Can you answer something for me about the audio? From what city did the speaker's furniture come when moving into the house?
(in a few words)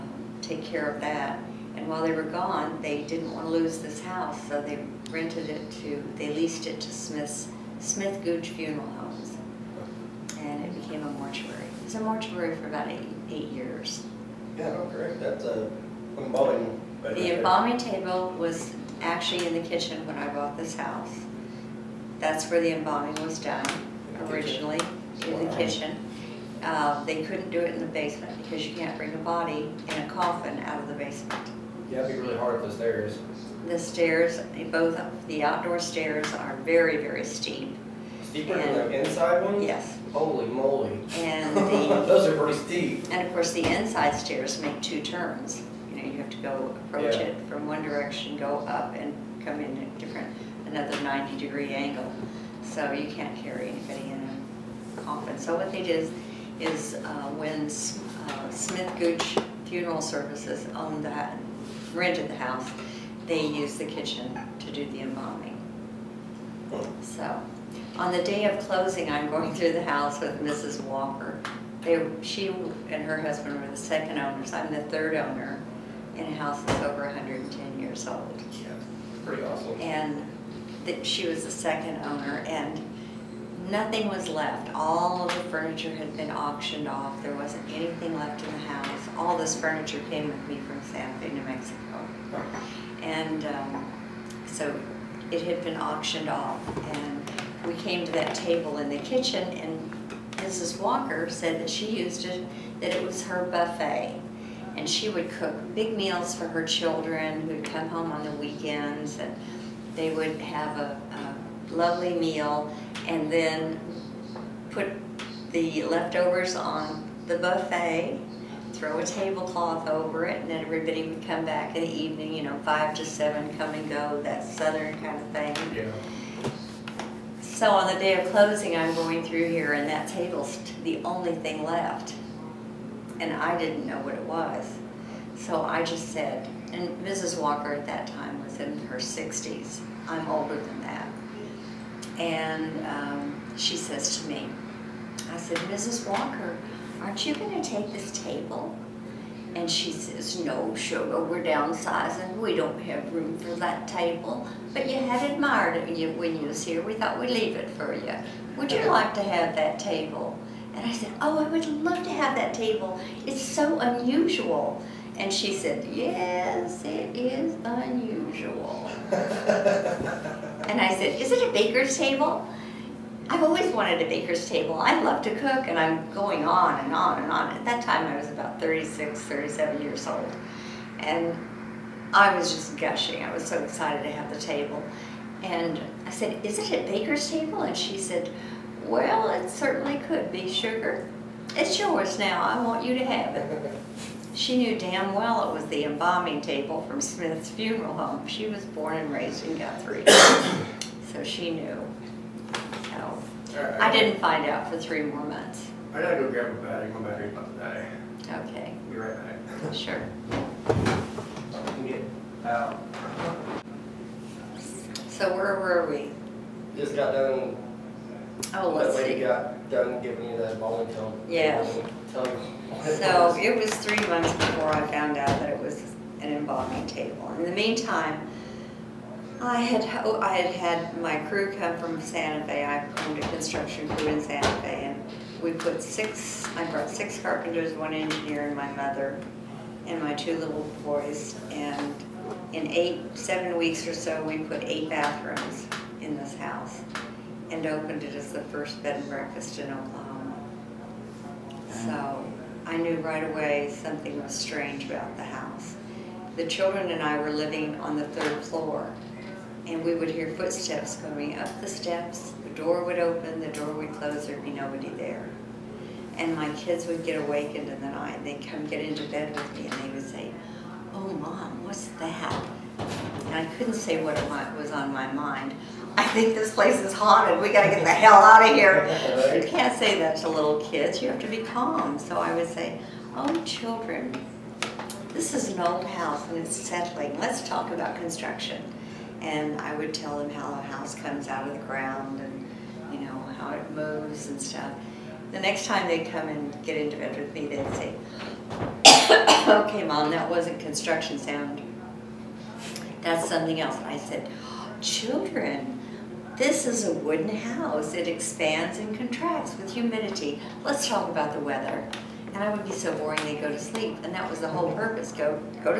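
Santa Fe, New Mexico.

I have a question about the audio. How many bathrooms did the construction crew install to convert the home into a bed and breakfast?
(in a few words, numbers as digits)
8.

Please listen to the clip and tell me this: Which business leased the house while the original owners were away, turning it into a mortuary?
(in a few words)
Smith Gooch Funeral Homes.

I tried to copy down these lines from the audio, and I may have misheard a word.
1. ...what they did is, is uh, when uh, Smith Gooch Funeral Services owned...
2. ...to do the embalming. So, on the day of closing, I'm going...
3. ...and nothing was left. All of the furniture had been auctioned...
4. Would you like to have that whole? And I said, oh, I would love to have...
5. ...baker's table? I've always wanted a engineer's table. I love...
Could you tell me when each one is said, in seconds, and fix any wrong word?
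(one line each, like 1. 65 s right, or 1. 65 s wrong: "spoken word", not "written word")
1. 55 s right
2. 64 s right
3. 82 s right
4. 158 s wrong: "table", not "whole"
5. 171 s wrong: "baker", not "engineer".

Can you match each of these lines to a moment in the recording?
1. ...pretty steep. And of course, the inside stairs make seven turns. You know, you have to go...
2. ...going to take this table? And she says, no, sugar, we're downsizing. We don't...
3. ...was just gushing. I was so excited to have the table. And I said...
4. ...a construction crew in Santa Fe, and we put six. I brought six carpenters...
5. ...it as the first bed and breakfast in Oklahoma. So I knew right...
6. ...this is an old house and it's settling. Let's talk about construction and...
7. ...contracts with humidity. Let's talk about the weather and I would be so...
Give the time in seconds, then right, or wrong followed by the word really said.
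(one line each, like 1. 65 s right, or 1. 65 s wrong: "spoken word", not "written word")
1. 42 s wrong: "two", not "seven"
2. 147 s right
3. 182 s right
4. 233 s right
5. 248 s right
6. 285 s right
7. 308 s right.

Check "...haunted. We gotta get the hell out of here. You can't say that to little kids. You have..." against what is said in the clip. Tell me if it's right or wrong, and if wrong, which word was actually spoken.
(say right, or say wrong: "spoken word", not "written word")
right.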